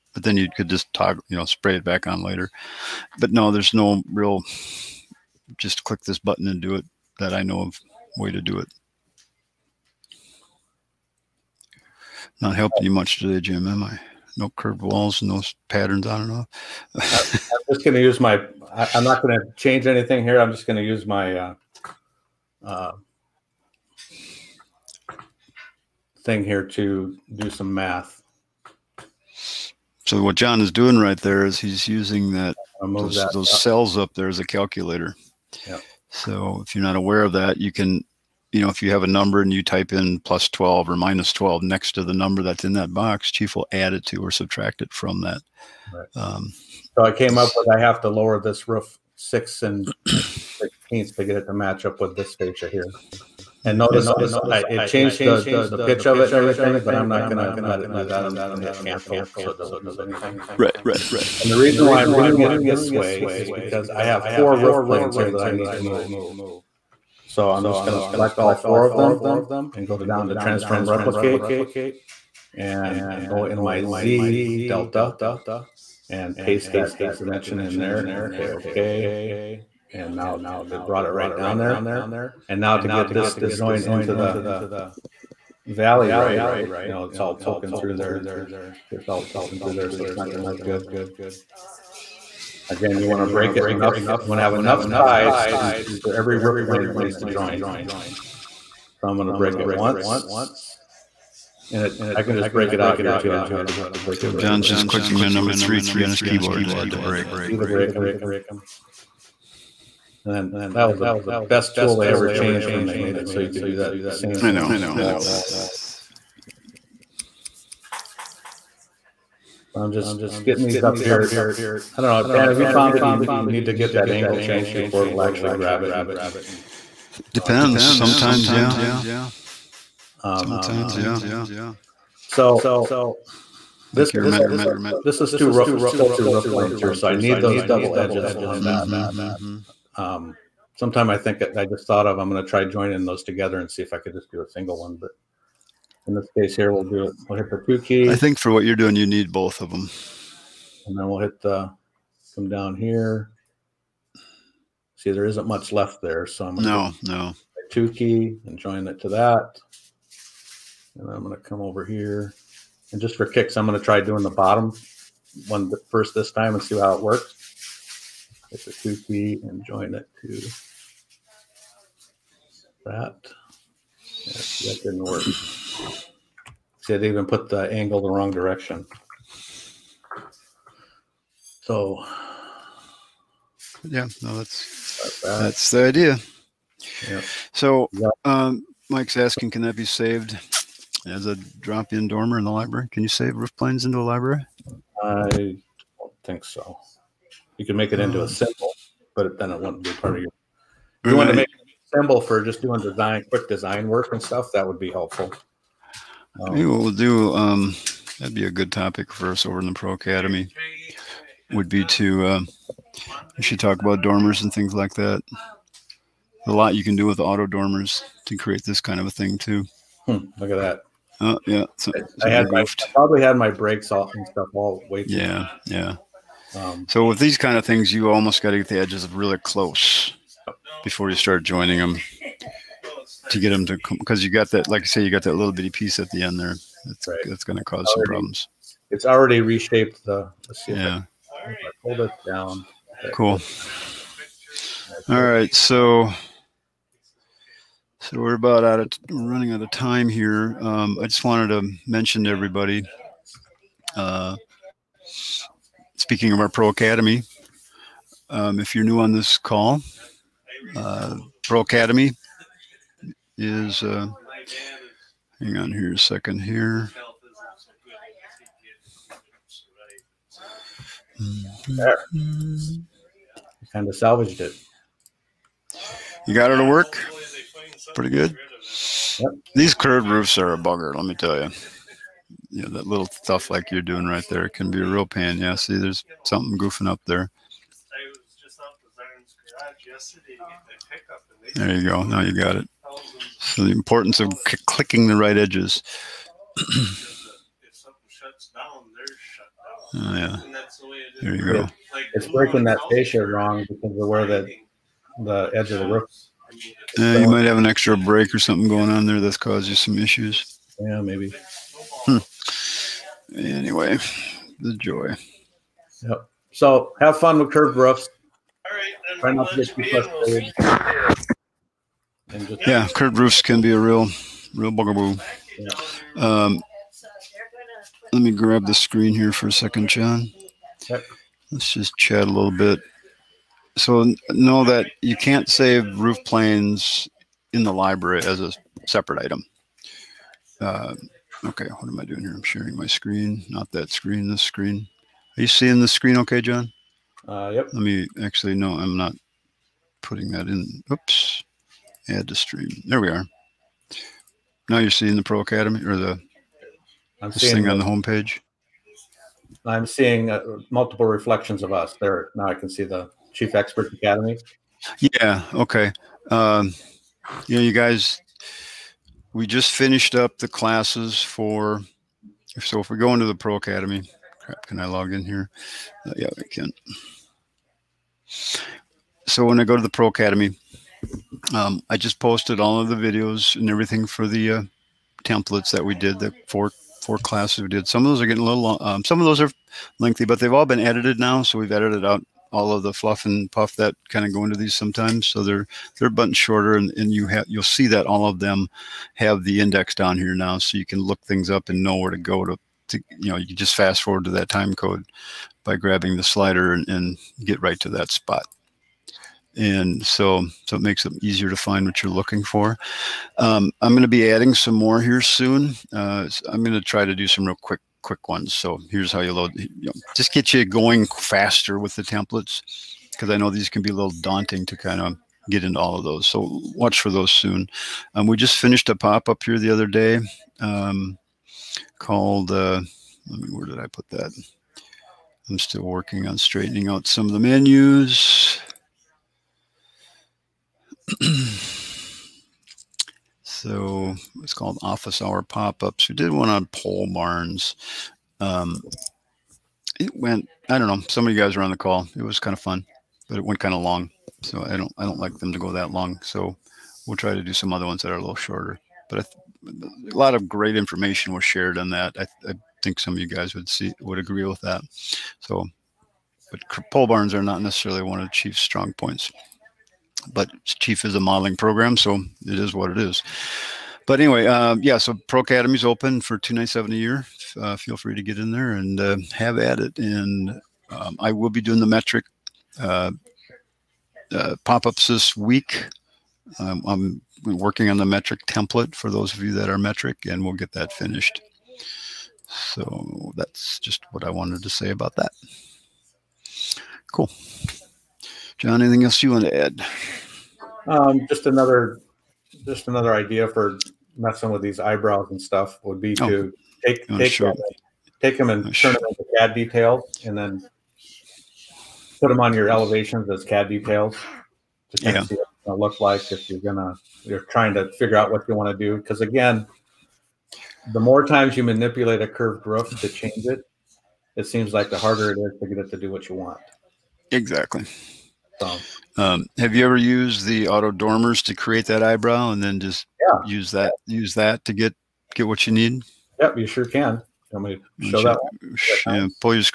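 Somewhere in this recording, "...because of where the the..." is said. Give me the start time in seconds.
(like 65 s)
303 s.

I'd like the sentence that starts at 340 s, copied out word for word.
Uh, okay, what am I doing here?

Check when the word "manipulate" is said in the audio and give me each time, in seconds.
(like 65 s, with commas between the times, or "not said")
521 s.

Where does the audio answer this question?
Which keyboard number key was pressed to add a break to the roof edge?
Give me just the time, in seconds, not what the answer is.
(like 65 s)
105 s.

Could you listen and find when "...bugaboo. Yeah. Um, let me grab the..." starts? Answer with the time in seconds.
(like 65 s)
324 s.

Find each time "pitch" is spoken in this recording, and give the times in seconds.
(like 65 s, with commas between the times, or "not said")
55 s.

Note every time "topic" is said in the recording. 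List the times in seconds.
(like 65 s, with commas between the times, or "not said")
208 s.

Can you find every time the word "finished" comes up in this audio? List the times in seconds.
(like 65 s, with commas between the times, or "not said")
369 s, 428 s, 490 s.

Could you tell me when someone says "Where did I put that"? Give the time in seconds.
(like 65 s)
433 s.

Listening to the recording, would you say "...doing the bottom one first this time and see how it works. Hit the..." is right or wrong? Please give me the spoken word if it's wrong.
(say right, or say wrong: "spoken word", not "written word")
right.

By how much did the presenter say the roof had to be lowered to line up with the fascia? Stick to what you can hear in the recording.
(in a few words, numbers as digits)
6 and 16.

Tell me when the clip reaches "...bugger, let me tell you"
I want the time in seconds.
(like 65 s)
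280 s.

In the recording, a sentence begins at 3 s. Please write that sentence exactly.
But no, there's no real, just click this button and do it that I know of way to do it.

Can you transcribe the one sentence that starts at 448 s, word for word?
Um, it went, I don't know, some of you guys were on the call.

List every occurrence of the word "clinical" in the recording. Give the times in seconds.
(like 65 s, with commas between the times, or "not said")
not said.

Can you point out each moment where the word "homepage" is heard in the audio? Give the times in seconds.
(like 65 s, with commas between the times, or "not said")
357 s.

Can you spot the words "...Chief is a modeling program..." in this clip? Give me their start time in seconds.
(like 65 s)
470 s.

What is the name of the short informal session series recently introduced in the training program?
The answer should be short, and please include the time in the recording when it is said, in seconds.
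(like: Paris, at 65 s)
office hour pop-ups, at 444 s.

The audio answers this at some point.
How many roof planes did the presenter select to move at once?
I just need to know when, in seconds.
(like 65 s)
64 s.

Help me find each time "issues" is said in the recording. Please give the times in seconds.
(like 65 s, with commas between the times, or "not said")
309 s.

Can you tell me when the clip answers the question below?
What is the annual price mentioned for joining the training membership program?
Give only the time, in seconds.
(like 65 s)
476 s.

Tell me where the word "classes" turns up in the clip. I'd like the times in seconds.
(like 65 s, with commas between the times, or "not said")
370 s, 387 s.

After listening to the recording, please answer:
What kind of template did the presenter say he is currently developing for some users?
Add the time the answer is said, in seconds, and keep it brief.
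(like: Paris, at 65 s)
metric template, at 488 s.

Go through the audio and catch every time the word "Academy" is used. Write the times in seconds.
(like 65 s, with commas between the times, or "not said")
209 s, 256 s, 261 s, 355 s, 363 s, 373 s, 380 s, 475 s.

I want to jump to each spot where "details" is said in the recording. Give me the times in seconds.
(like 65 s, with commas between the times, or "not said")
509 s, 513 s.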